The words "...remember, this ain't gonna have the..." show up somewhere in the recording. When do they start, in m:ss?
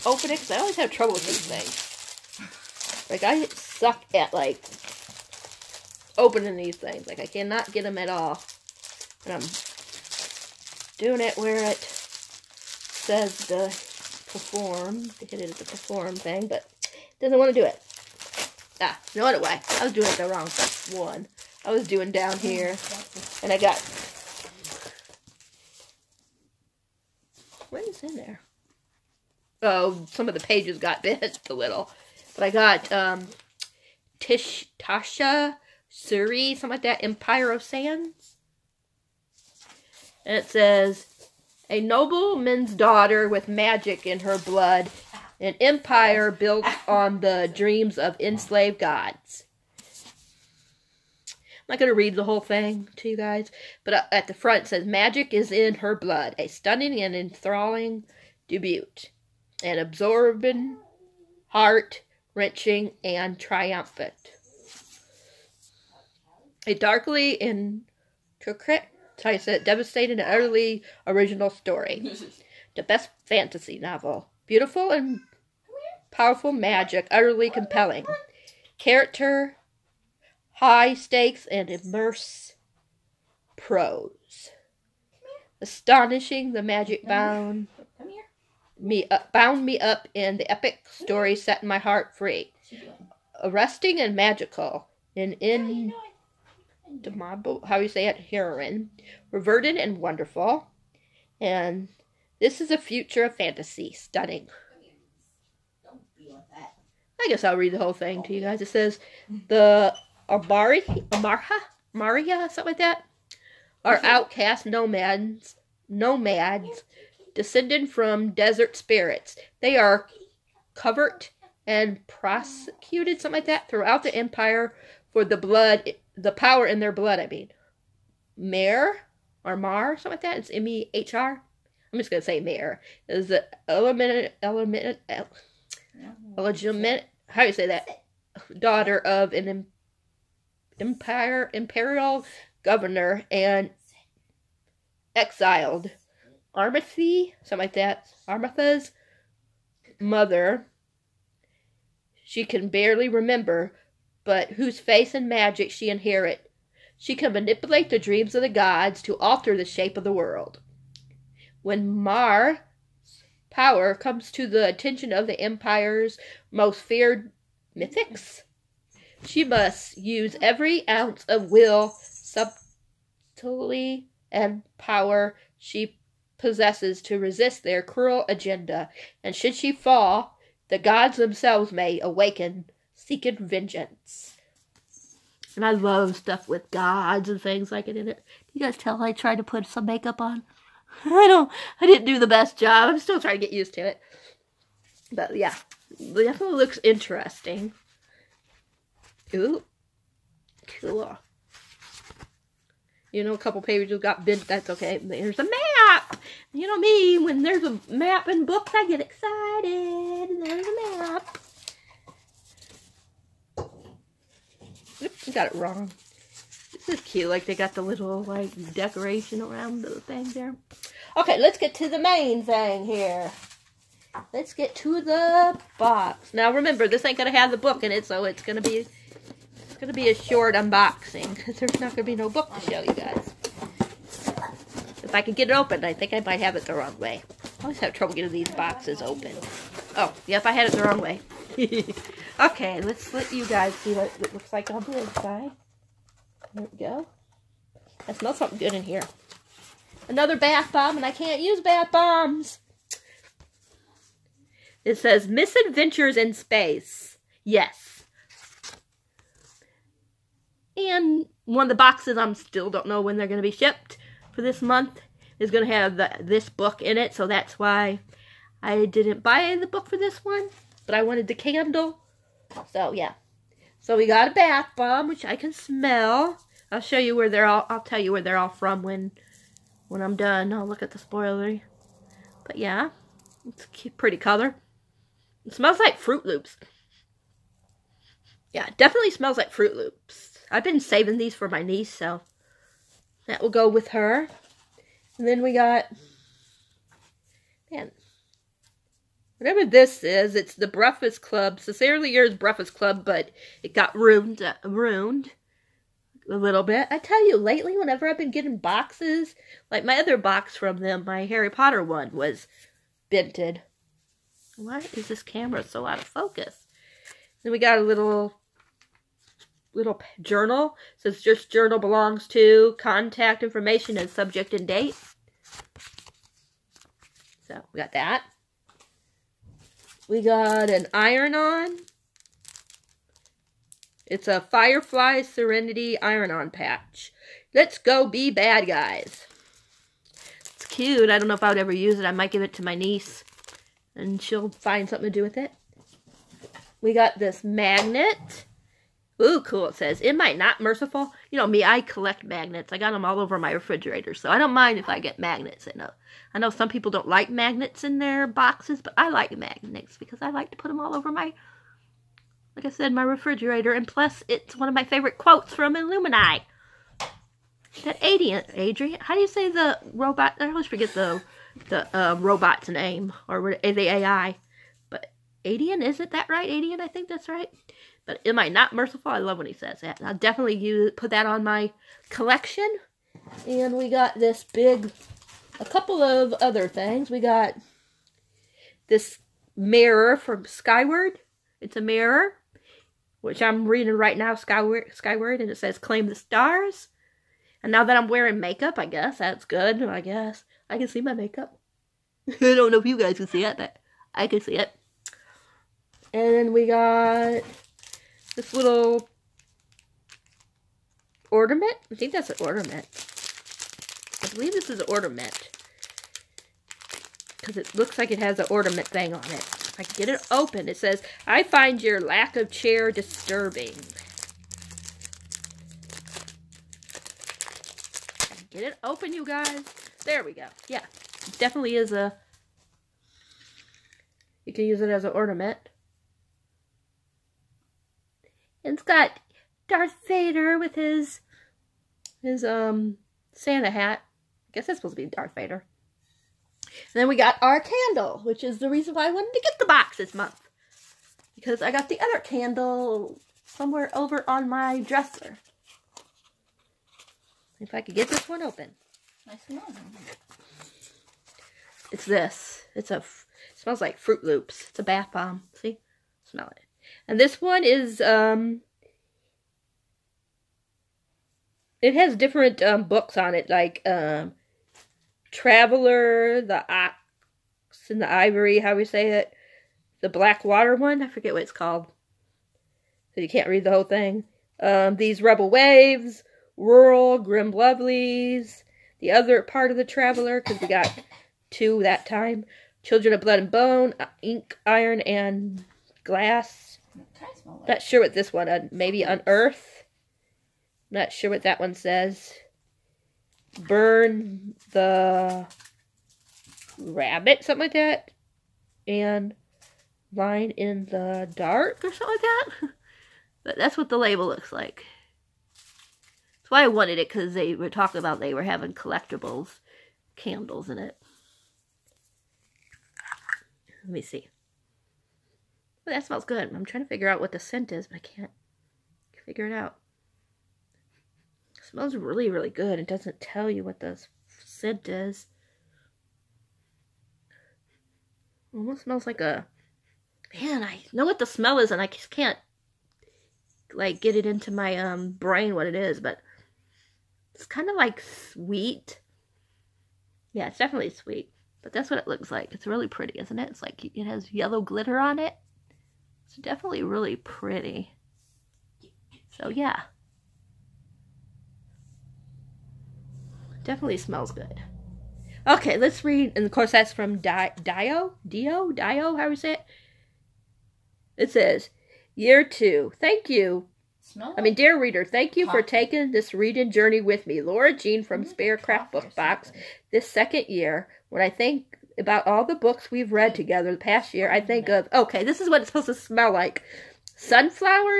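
3:46.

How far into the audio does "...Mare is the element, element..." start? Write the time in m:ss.
2:12.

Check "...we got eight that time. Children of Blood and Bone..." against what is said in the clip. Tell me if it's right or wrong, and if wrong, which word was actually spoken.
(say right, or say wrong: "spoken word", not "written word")
wrong: "two", not "eight".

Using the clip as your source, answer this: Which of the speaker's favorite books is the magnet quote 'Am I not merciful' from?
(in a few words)
Illuminae.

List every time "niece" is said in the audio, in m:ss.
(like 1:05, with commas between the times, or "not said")
4:51, 5:42.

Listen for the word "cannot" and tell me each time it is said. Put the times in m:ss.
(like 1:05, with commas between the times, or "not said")
0:07.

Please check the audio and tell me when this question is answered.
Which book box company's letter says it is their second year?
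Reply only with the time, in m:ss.
9:38.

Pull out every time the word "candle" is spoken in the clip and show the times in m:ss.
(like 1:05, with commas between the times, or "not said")
4:31, 7:27, 7:32, 8:40.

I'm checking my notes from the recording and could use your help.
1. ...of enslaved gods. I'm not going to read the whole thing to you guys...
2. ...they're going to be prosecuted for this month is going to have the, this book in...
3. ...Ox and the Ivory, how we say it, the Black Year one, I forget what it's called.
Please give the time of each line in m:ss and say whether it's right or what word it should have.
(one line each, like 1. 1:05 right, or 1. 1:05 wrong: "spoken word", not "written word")
1. 0:47 right
2. 4:23 wrong: "shipped", not "prosecuted"
3. 7:56 wrong: "Water", not "Year".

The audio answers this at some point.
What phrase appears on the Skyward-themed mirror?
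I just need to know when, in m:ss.
6:35.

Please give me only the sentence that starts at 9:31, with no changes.
It says, Year two, thank you.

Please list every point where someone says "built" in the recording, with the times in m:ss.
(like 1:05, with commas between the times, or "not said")
0:46.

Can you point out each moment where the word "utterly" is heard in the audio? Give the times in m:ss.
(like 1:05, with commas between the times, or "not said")
1:10, 1:17.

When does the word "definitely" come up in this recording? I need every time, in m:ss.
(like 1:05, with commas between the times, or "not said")
3:16, 4:48, 6:20, 7:11, 9:10, 9:16, 9:23.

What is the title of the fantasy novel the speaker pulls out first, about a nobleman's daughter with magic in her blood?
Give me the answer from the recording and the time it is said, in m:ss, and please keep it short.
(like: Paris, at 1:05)
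Empire of Sands, at 0:37.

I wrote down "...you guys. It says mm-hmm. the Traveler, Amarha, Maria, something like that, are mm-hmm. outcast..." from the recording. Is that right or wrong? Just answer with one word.
wrong.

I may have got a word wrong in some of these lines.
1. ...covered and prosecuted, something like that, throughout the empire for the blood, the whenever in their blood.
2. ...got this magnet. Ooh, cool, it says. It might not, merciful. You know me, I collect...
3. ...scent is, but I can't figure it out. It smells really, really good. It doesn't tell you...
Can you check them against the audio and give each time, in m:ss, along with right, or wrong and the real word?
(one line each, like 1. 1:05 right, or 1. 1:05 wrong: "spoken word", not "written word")
1. 2:00 wrong: "power", not "whenever"
2. 5:46 right
3. 8:47 right.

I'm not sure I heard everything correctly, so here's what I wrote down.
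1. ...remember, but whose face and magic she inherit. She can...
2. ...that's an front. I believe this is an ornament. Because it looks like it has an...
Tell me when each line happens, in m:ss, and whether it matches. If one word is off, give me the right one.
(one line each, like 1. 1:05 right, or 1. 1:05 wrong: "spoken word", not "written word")
1. 2:33 right
2. 6:52 wrong: "ornament", not "front".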